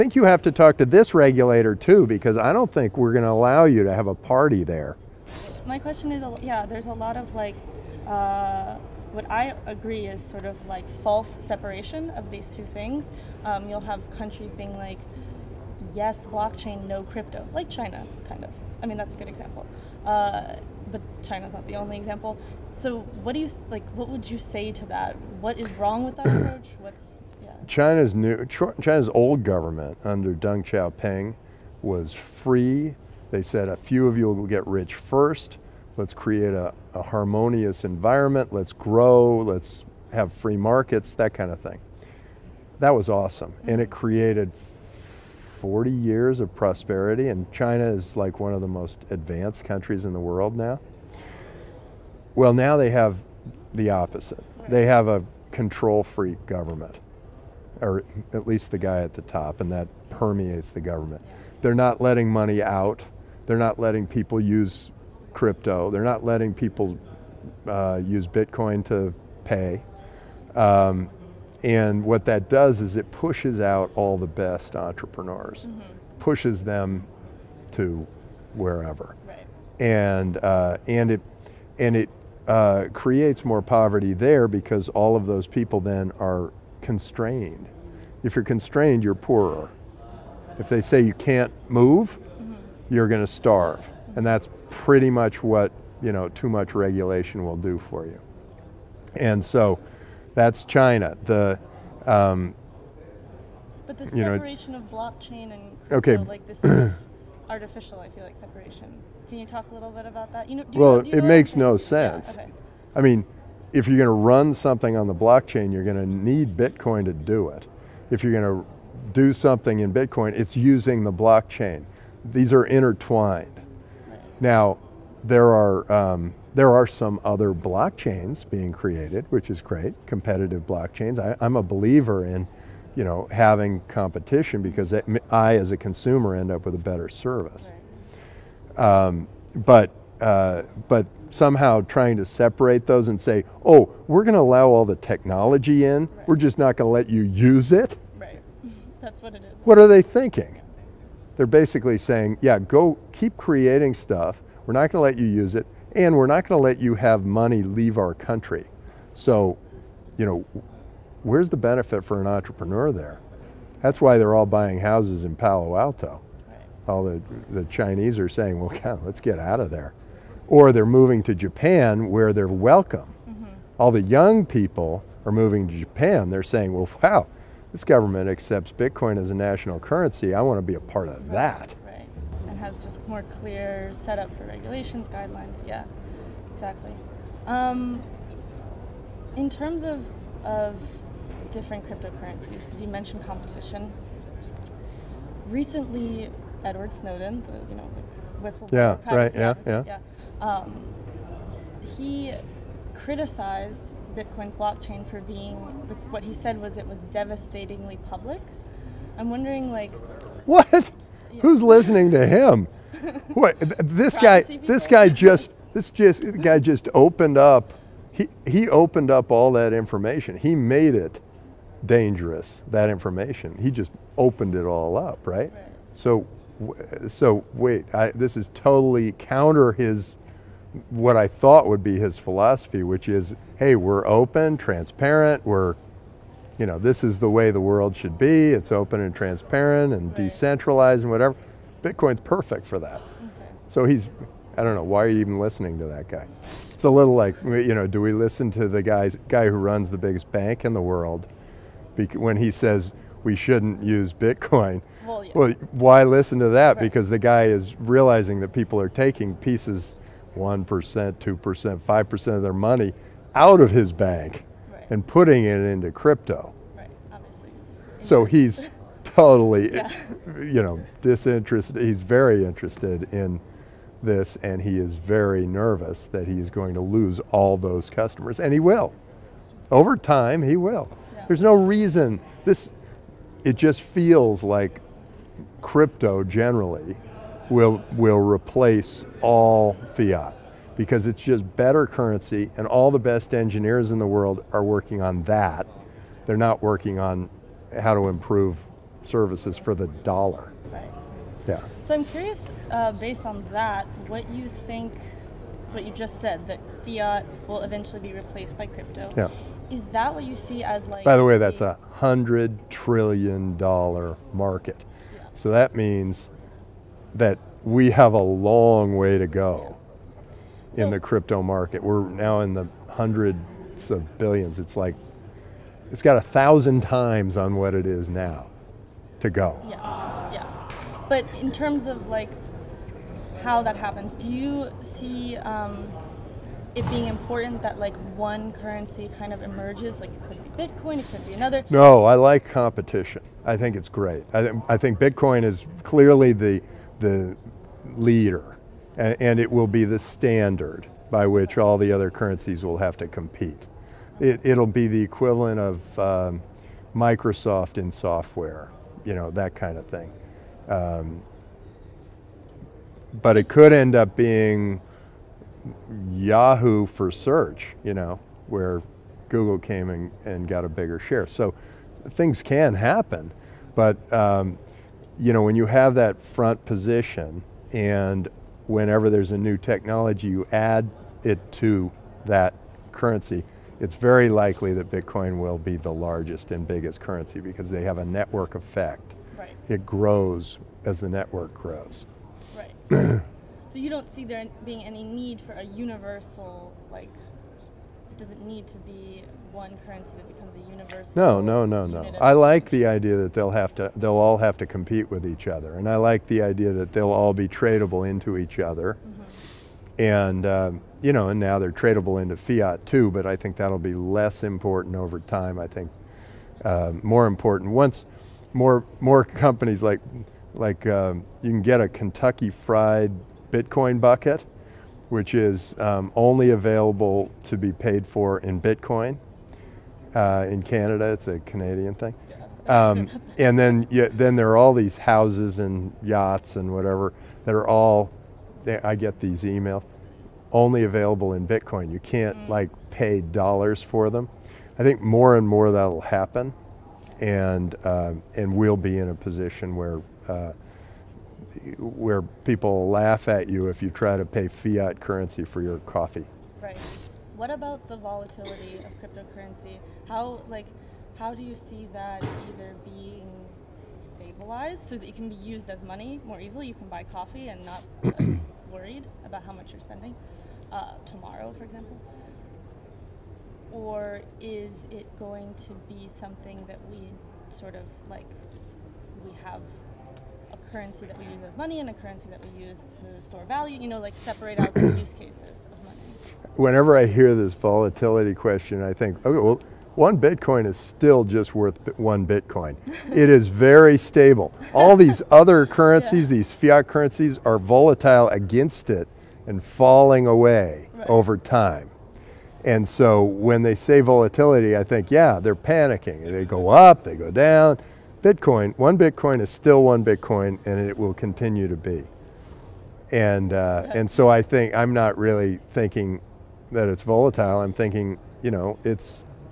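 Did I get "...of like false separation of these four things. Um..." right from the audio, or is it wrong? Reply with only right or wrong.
wrong.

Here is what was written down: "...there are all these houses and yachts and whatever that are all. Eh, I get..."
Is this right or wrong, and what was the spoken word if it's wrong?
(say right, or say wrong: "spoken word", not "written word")
right.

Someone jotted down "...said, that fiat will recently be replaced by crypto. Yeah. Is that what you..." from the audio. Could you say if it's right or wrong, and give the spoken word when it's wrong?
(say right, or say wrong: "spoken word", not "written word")
wrong: "eventually", not "recently".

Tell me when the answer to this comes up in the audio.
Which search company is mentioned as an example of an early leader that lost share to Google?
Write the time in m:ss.
6:06.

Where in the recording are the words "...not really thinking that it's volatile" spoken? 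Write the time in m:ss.
8:34.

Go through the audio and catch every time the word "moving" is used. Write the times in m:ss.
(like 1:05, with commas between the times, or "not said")
2:50, 2:55.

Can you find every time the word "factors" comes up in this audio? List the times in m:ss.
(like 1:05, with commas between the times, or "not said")
not said.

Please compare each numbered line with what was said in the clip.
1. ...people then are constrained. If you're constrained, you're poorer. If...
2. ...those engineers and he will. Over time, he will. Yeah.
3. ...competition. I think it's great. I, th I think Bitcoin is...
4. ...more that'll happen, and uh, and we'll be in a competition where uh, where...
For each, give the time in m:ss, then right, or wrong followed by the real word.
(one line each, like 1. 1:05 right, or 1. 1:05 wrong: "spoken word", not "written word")
1. 1:25 right
2. 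4:37 wrong: "customers", not "engineers"
3. 5:42 right
4. 7:25 wrong: "position", not "competition".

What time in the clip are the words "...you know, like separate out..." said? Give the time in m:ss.
8:03.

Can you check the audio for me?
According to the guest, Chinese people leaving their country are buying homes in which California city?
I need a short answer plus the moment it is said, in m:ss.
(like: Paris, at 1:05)
Palo Alto, at 2:45.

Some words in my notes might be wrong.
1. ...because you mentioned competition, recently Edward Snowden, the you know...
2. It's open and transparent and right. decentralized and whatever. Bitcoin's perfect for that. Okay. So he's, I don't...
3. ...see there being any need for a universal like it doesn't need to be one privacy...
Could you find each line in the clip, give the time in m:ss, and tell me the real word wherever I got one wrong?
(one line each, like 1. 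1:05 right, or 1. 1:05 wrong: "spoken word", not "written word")
1. 3:12 right
2. 3:58 right
3. 6:34 wrong: "currency", not "privacy".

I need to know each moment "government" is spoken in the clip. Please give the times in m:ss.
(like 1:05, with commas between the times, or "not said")
0:29, 0:56, 1:00, 2:57.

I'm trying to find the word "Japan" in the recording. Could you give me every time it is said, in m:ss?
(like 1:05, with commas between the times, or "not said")
2:51, 2:55.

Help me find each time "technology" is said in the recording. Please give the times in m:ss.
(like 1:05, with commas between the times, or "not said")
2:24, 6:19.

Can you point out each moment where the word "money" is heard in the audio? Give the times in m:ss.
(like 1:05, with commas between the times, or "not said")
1:02, 2:37, 4:22, 7:45, 8:01, 8:05.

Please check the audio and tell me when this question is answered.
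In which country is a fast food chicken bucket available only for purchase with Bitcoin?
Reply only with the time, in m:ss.
7:10.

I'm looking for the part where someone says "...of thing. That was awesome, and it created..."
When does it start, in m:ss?
0:41.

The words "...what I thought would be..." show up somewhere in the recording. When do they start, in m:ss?
3:50.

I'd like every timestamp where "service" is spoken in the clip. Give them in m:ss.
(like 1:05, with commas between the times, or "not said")
2:17, 4:59.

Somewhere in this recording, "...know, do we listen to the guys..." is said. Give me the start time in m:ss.
4:07.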